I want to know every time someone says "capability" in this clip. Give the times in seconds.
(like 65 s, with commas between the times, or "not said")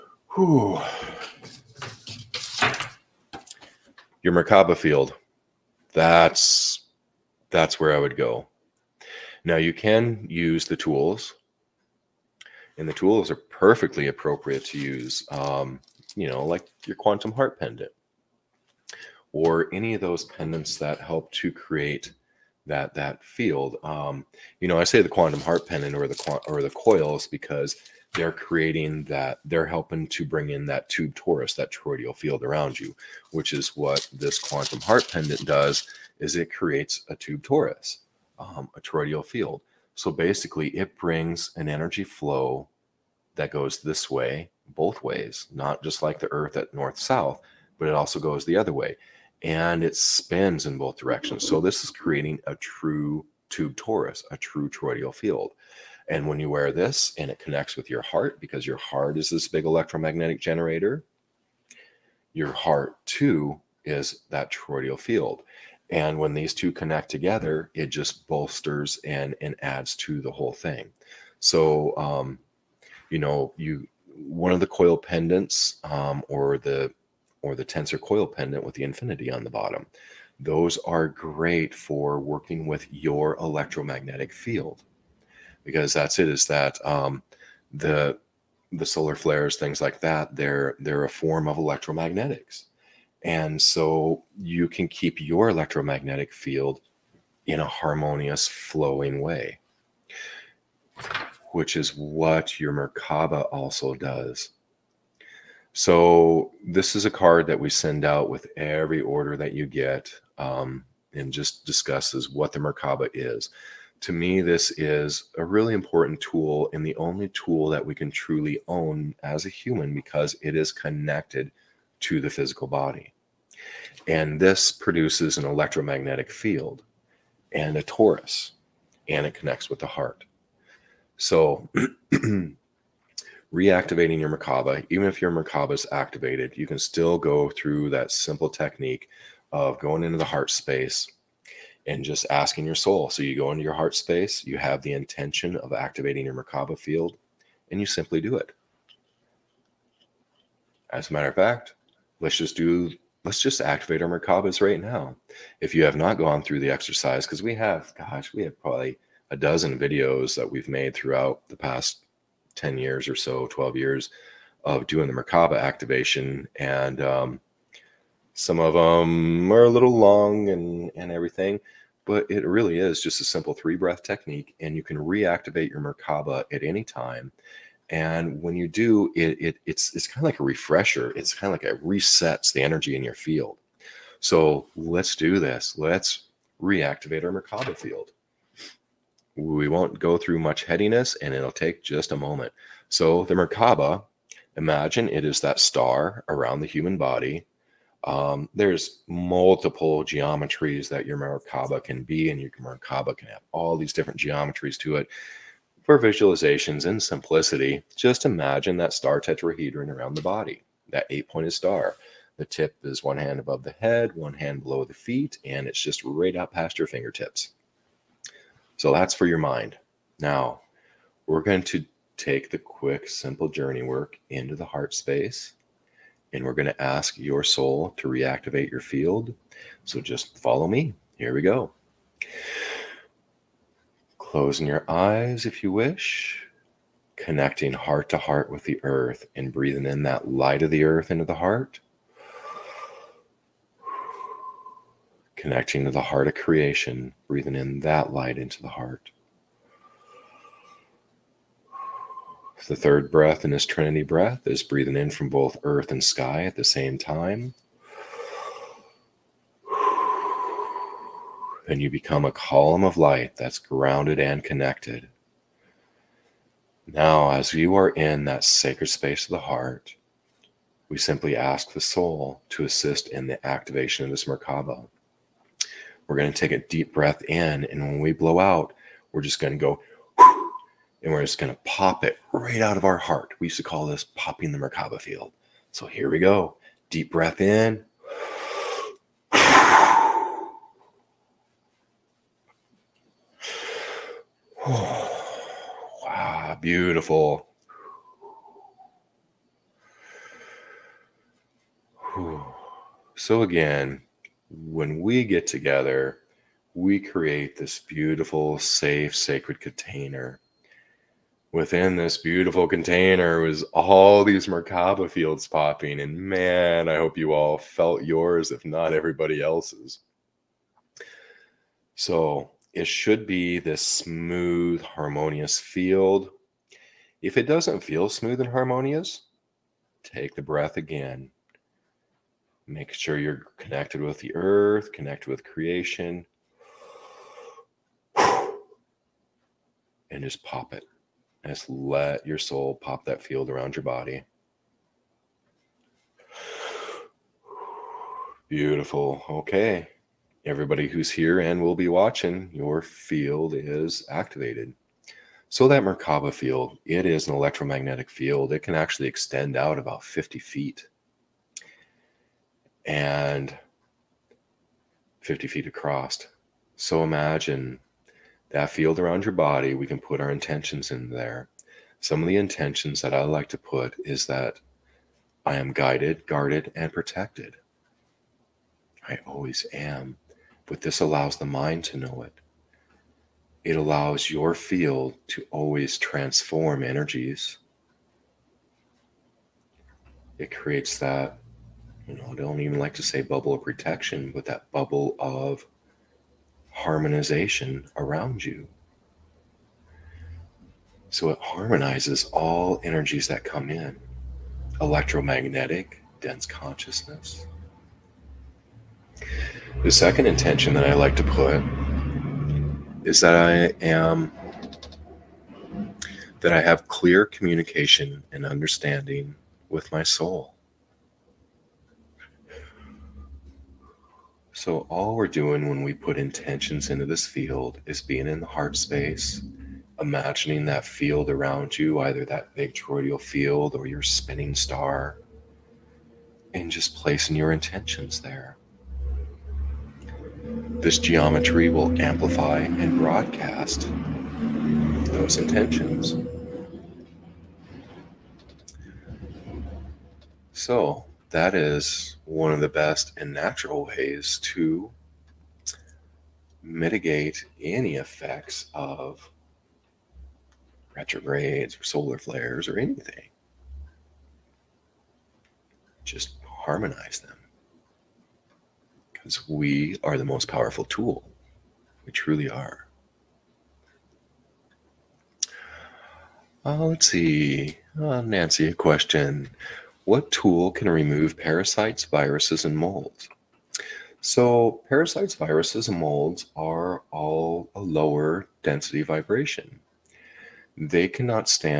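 not said.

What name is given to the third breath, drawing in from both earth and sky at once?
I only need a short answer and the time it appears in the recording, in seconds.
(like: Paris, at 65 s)
Trinity breath, at 253 s.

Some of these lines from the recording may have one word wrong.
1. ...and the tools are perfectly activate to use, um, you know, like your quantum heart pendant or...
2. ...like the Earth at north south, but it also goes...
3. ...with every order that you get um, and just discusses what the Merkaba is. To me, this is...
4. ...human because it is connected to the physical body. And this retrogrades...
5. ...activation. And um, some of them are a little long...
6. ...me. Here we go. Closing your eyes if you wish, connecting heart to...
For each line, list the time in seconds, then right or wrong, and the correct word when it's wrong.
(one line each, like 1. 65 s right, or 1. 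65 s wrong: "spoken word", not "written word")
1. 12 s wrong: "appropriate", not "activate"
2. 46 s right
3. 108 s right
4. 119 s wrong: "produces", not "retrogrades"
5. 165 s right
6. 230 s right.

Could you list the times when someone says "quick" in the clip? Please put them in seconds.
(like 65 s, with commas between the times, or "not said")
222 s.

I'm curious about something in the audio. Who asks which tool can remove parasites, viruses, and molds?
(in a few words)
Nancy.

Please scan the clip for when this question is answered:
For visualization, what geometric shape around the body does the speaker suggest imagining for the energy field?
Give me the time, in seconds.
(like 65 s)
208 s.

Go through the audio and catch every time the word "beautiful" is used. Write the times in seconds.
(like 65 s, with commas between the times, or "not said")
296 s, 307 s, 312 s, 348 s.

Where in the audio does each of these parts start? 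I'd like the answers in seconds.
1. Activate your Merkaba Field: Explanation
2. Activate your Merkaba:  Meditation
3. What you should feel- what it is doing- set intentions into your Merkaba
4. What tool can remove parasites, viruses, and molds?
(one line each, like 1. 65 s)
1. 153 s
2. 232 s
3. 304 s
4. 476 s.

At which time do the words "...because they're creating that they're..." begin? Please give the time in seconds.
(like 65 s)
27 s.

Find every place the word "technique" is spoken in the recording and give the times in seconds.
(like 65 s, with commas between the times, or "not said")
138 s, 174 s.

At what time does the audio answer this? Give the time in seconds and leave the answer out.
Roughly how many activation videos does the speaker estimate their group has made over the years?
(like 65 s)
159 s.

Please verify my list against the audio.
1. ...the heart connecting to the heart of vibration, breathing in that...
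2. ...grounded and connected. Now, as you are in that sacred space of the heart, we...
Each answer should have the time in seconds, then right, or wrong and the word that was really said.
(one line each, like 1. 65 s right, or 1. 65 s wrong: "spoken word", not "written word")
1. 241 s wrong: "creation", not "vibration"
2. 263 s right.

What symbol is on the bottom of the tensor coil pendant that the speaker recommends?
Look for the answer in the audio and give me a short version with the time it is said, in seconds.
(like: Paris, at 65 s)
infinity, at 78 s.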